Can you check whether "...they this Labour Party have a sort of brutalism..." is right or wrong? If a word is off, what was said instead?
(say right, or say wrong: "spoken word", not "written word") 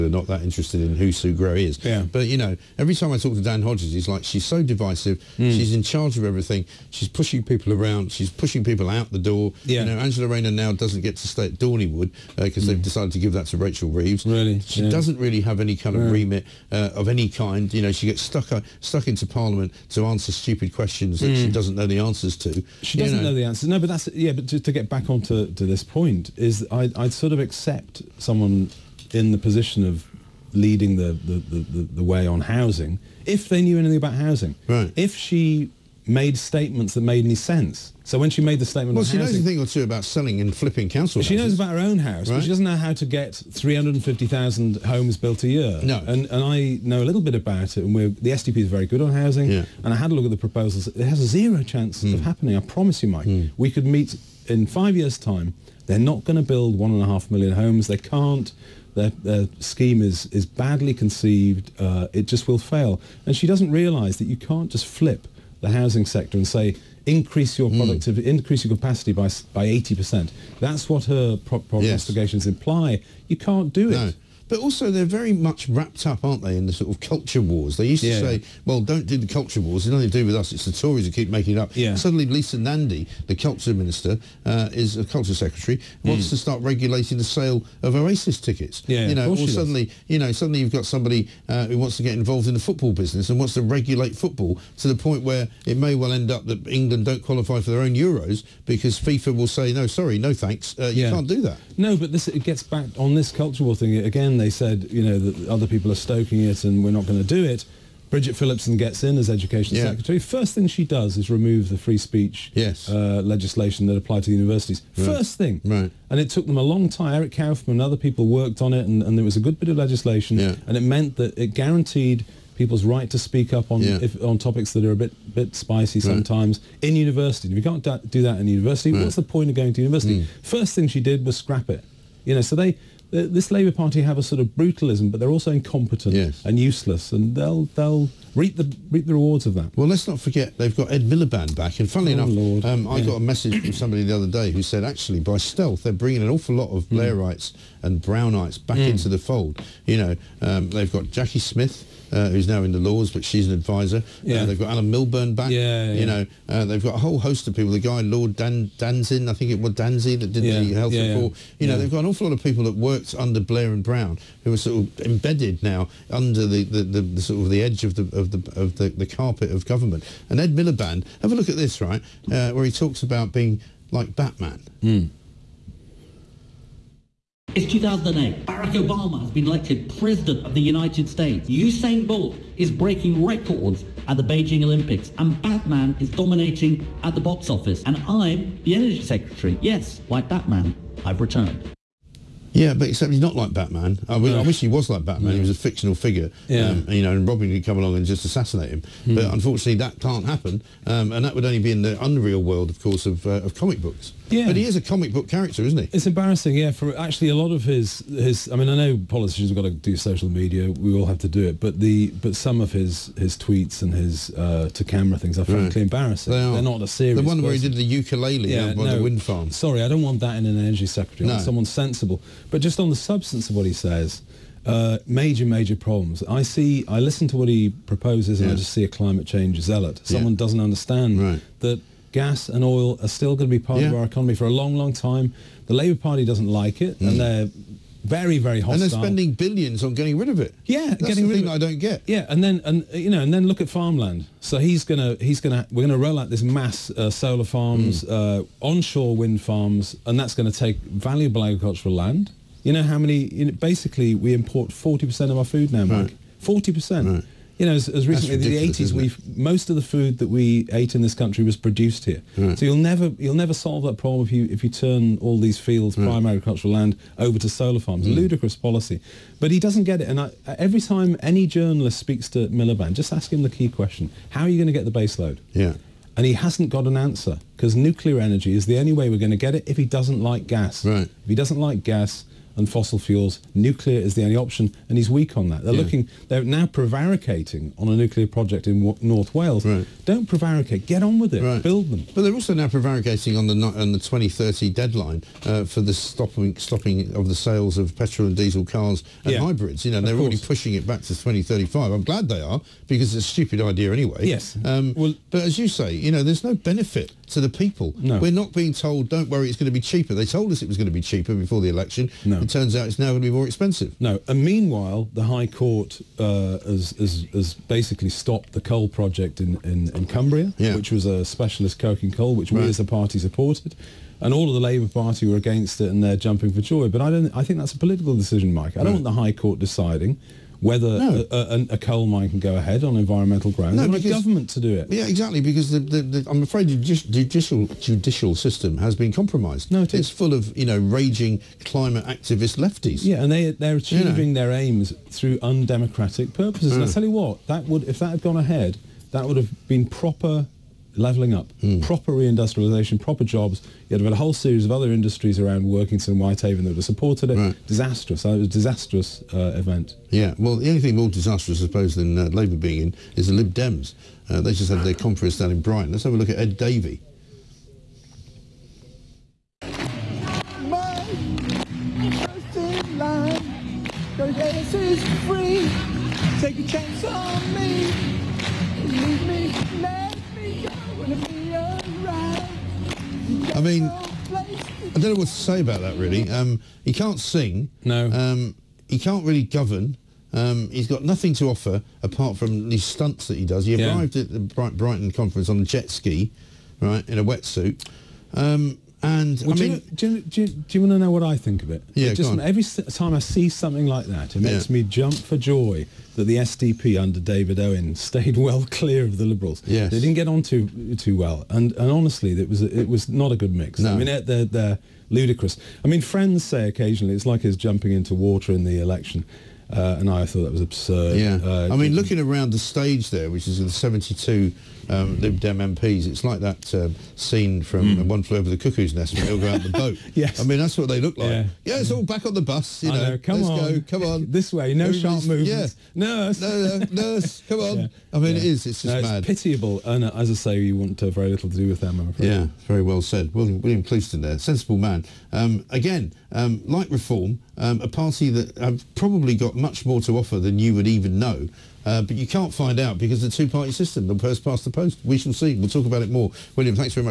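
right.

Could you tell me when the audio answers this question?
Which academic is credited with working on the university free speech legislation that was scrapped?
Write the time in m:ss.
1:57.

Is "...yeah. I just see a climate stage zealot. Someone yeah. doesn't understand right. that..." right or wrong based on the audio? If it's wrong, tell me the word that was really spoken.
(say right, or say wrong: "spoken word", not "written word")
wrong: "change", not "stage".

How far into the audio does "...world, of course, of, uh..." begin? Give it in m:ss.
3:22.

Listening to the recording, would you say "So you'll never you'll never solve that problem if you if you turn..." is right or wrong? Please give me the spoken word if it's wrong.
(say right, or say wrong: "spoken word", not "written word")
right.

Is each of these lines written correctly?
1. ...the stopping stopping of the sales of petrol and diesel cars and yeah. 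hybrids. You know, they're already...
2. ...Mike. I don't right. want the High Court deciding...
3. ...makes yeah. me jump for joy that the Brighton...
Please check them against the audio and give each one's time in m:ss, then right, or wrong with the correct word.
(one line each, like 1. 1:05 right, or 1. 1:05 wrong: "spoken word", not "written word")
1. 4:55 right
2. 5:28 right
3. 6:44 wrong: "SDP", not "Brighton".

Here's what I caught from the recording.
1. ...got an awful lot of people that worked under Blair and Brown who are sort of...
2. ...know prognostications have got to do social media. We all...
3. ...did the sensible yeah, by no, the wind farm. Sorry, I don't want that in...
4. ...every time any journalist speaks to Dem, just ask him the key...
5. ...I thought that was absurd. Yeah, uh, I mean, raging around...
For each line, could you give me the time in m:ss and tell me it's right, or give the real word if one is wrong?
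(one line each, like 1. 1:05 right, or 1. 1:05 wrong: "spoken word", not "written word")
1. 2:41 right
2. 3:28 wrong: "politicians", not "prognostications"
3. 3:37 wrong: "ukulele", not "sensible"
4. 4:30 wrong: "Miliband", not "Dem"
5. 7:00 wrong: "looking", not "raging".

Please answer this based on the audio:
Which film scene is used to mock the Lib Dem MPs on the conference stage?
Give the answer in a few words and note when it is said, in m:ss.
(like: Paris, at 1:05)
One Flew Over the Cuckoo's Nest, at 7:08.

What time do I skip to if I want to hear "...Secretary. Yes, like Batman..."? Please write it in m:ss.
3:09.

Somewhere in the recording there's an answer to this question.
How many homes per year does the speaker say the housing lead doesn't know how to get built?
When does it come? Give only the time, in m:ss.
0:43.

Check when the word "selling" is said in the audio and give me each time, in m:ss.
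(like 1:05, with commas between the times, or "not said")
0:40.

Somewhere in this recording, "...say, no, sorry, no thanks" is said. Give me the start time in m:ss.
1:39.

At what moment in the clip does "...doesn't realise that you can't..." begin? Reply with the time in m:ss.
1:03.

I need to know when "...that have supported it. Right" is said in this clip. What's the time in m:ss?
5:56.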